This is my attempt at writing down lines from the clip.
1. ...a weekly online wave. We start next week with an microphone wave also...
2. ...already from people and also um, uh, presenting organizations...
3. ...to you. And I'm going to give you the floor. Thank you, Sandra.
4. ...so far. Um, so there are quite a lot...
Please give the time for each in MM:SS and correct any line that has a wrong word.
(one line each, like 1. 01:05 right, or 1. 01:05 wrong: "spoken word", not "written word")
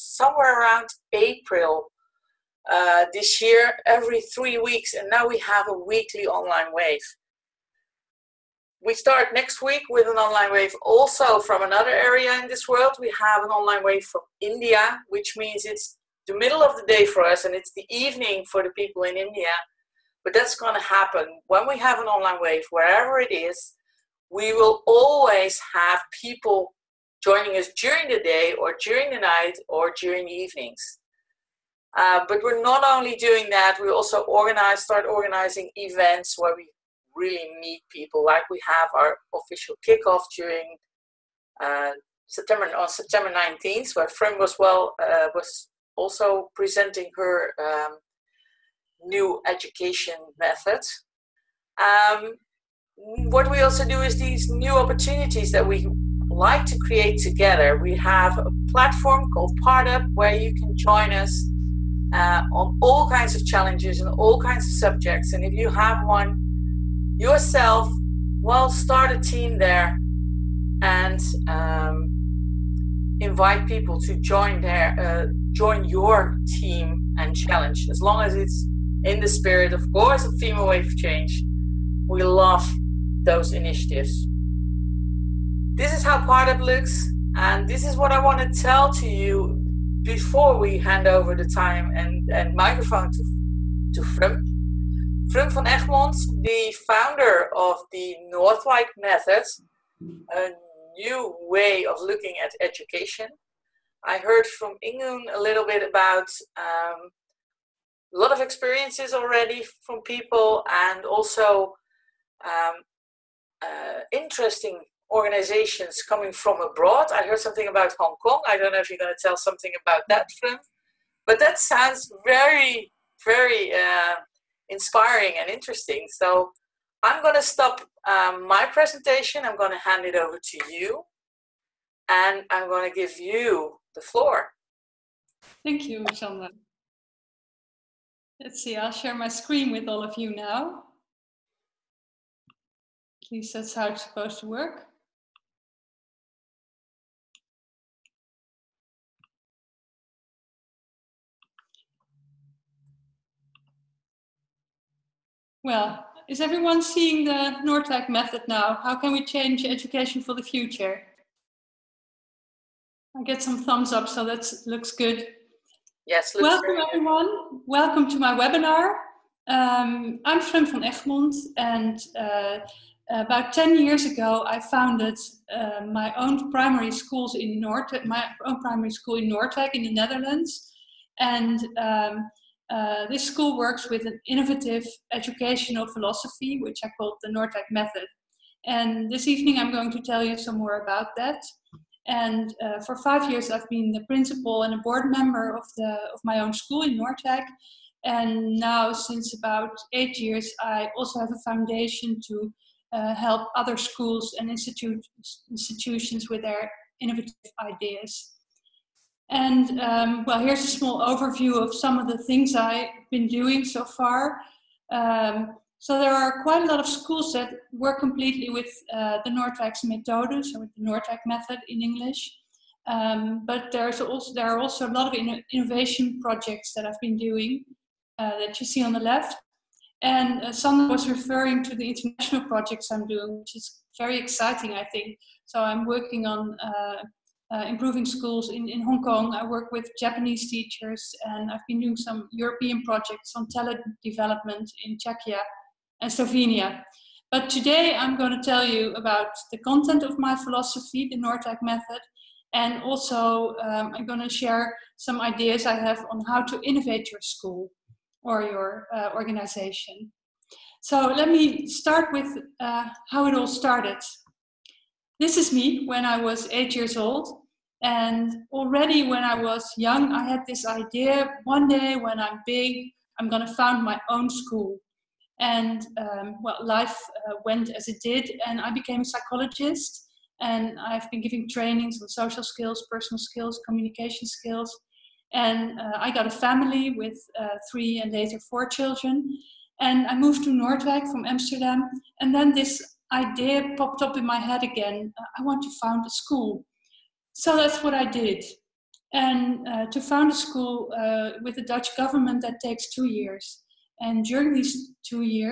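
1. 00:05 wrong: "online", not "microphone"
2. 01:49 wrong: "interesting", not "presenting"
3. 02:10 right
4. 03:33 right.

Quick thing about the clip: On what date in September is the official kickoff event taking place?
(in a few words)
September 19th.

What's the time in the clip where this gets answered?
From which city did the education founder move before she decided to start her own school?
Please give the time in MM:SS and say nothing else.
04:51.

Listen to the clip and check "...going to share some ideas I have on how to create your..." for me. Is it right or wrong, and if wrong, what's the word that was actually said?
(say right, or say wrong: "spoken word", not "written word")
wrong: "innovate", not "create".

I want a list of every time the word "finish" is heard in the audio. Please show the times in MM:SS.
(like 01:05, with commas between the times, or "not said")
not said.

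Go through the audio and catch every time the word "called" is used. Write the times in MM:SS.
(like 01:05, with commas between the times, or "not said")
00:59, 03:06.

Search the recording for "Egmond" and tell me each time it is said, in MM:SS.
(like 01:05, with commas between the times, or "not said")
01:35, 02:50.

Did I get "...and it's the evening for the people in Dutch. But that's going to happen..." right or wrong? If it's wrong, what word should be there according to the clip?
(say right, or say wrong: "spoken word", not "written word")
wrong: "India", not "Dutch".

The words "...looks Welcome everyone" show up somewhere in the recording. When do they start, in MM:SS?
02:46.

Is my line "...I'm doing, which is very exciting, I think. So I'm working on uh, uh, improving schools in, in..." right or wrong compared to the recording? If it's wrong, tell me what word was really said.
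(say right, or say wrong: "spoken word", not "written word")
right.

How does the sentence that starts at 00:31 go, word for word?
Um, but we're not only doing that, we also organize, start organizing events where we really meet people.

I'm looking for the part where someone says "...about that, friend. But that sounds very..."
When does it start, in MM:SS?
01:59.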